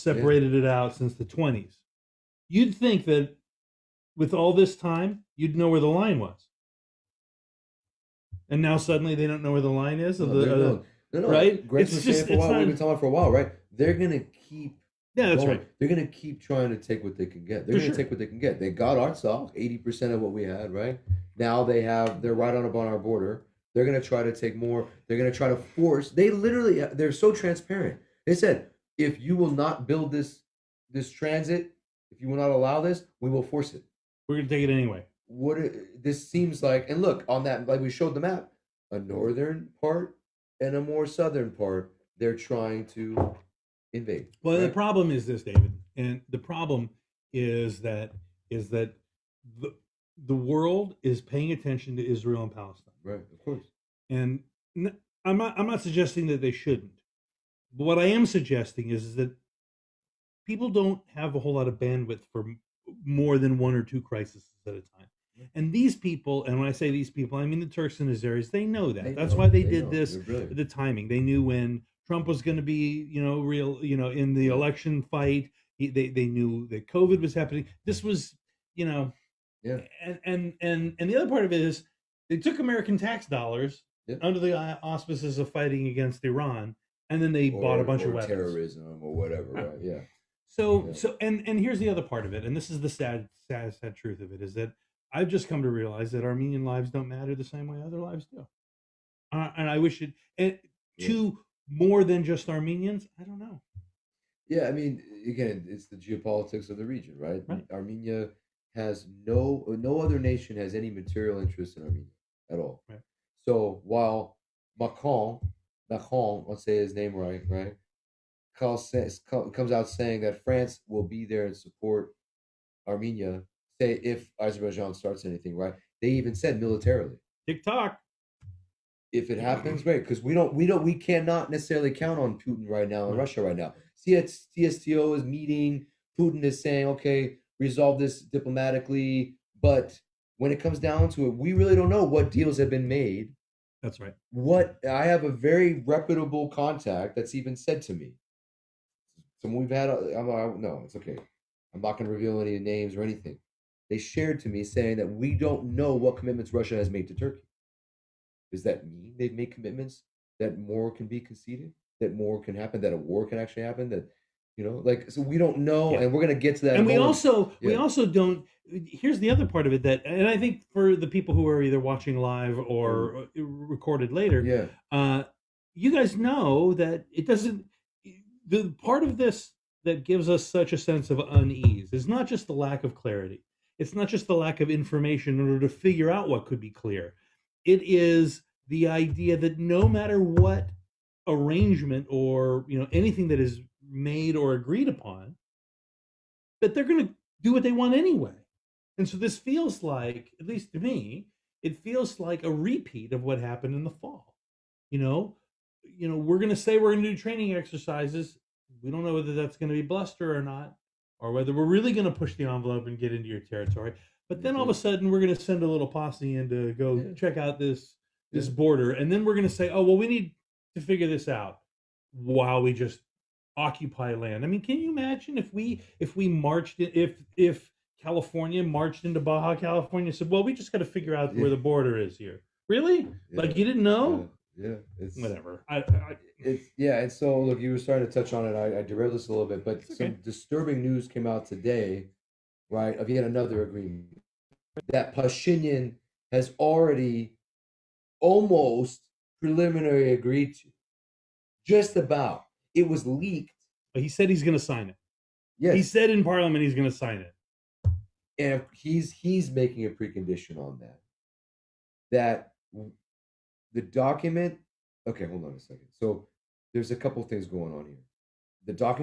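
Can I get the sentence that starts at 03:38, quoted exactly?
border, and then we're going to say, "Oh, well, we need to figure this out." While we just occupy land.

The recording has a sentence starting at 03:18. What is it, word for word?
And so this feels like, at least to me, it feels like a repeat of what happened in the fall.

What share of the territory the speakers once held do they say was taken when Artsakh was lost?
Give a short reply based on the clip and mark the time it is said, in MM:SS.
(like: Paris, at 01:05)
80%, at 00:19.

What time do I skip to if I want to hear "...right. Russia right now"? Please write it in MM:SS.
02:13.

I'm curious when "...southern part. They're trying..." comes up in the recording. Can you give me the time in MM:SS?
00:41.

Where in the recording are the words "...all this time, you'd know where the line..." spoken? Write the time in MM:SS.
00:04.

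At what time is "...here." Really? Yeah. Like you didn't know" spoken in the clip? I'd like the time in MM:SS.
03:52.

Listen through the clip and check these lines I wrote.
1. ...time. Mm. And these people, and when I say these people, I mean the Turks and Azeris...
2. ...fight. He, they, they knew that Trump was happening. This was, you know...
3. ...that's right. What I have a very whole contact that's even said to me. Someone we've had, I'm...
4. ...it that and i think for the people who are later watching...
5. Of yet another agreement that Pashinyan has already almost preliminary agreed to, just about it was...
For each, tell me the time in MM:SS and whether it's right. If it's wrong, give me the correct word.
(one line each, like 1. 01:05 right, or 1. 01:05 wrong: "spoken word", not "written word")
1. 01:04 right
2. 01:15 wrong: "COVID", not "Trump"
3. 02:23 wrong: "reputable", not "whole"
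4. 02:49 wrong: "either", not "later"
5. 04:02 right.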